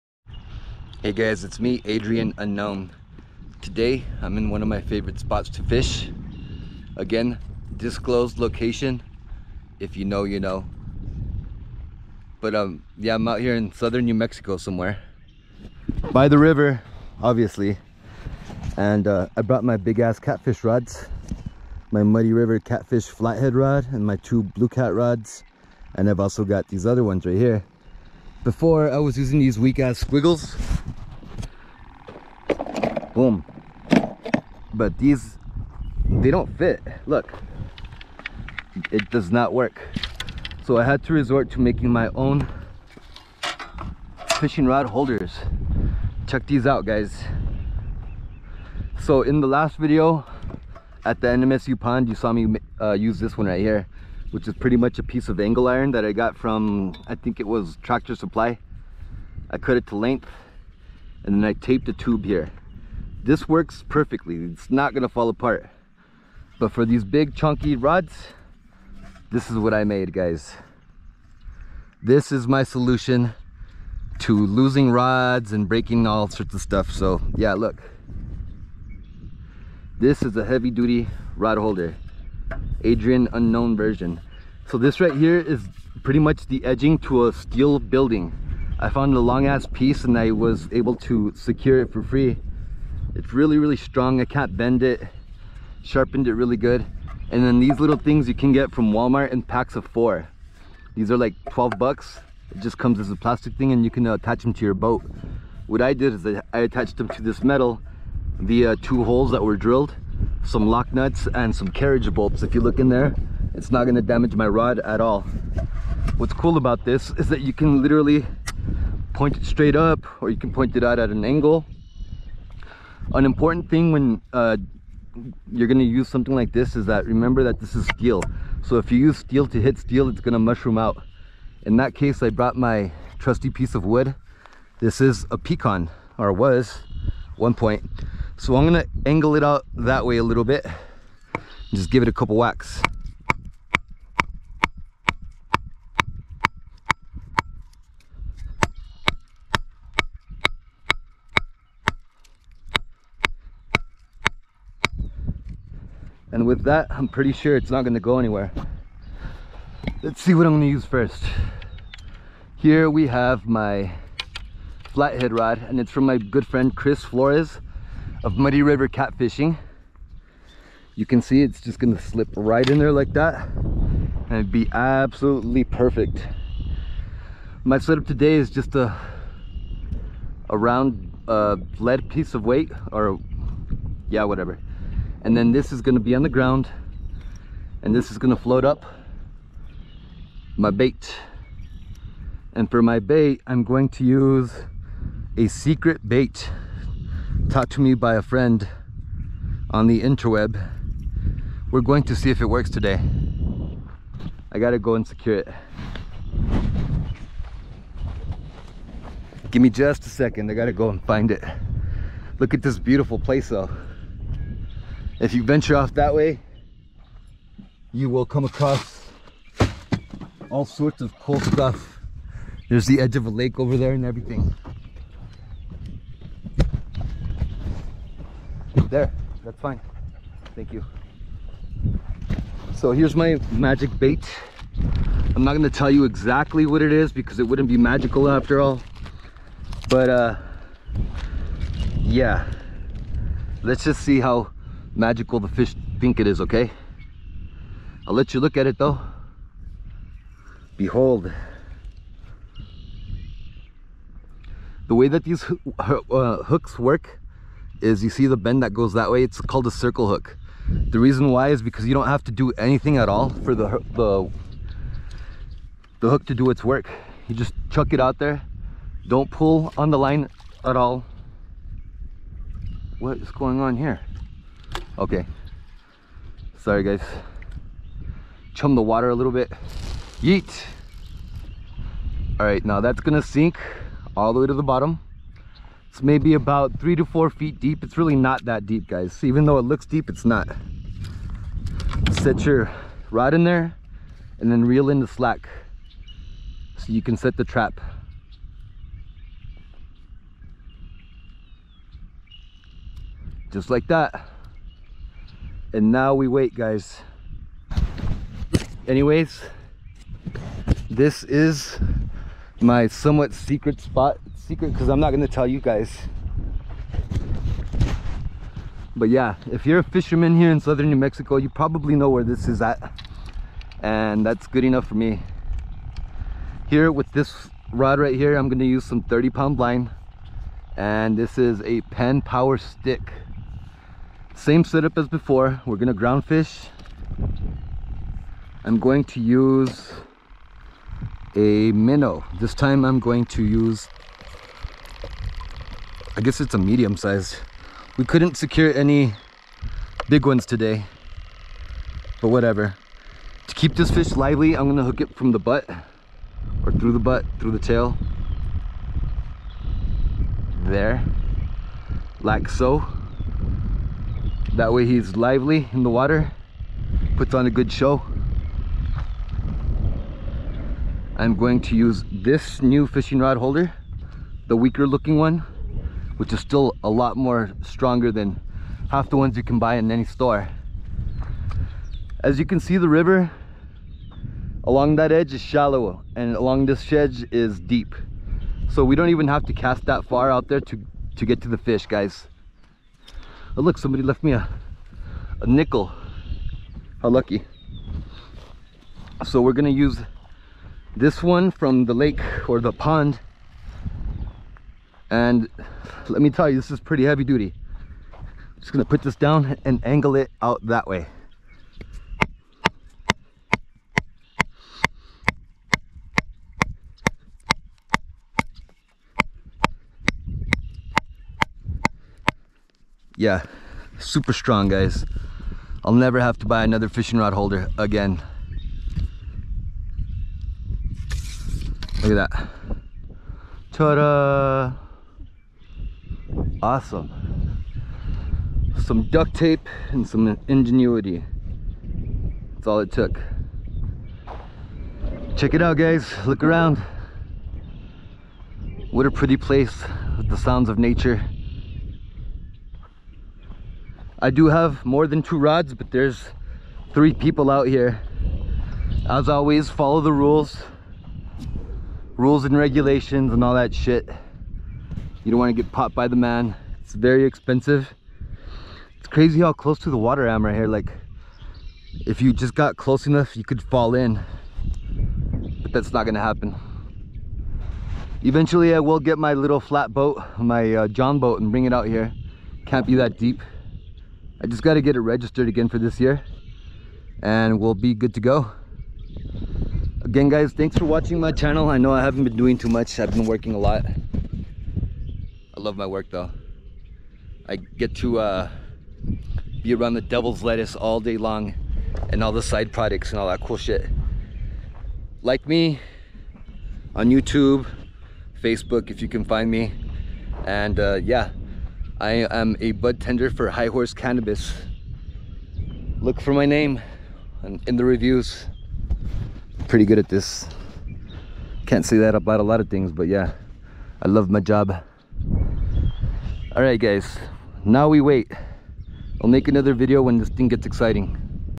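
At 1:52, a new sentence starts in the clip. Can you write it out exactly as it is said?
If you look in there, it's not gonna damage my rod at all.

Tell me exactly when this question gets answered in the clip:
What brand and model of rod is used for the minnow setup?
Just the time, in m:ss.
5:31.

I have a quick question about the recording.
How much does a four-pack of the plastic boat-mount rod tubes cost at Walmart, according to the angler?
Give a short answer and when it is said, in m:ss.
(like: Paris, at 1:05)
$12, at 1:41.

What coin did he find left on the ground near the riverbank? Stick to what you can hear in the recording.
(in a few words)
Nickel.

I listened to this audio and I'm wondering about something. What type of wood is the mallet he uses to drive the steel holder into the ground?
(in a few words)
Pecan.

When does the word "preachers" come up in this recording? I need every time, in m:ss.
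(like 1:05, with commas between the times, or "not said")
not said.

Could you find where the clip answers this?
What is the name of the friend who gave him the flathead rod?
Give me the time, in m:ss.
2:46.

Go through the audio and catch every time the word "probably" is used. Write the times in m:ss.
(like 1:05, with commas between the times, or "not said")
5:21.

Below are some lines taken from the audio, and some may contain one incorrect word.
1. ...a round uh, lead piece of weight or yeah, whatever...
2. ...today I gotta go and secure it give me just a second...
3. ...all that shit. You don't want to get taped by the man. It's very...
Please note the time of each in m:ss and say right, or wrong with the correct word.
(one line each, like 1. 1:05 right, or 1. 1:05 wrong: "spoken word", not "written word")
1. 3:00 right
2. 3:22 right
3. 7:43 wrong: "popped", not "taped".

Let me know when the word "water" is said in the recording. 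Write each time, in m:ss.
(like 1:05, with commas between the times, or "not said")
4:38, 6:05, 7:49.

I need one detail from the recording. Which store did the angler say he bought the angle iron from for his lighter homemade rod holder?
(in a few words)
Tractor Supply.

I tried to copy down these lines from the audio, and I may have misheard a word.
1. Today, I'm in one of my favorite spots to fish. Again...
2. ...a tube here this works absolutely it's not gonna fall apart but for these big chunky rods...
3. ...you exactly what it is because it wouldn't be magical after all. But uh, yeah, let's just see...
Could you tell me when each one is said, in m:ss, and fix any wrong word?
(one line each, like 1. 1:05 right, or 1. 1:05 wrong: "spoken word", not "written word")
1. 0:03 right
2. 1:01 wrong: "perfectly", not "absolutely"
3. 3:55 right.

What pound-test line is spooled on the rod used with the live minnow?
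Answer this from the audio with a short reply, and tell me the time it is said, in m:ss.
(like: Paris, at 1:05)
30 pound, at 5:29.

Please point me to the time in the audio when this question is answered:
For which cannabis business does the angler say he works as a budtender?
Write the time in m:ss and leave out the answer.
8:33.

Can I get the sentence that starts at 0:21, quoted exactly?
My Muddy River catfish flathead rod and my two blue cat rods.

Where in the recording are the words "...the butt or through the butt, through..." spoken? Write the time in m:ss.
5:55.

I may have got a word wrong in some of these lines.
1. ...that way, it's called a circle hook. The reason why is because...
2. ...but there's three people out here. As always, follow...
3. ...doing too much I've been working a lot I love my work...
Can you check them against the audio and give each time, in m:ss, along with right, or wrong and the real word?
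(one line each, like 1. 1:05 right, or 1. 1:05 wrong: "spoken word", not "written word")
1. 4:18 right
2. 7:35 right
3. 8:12 right.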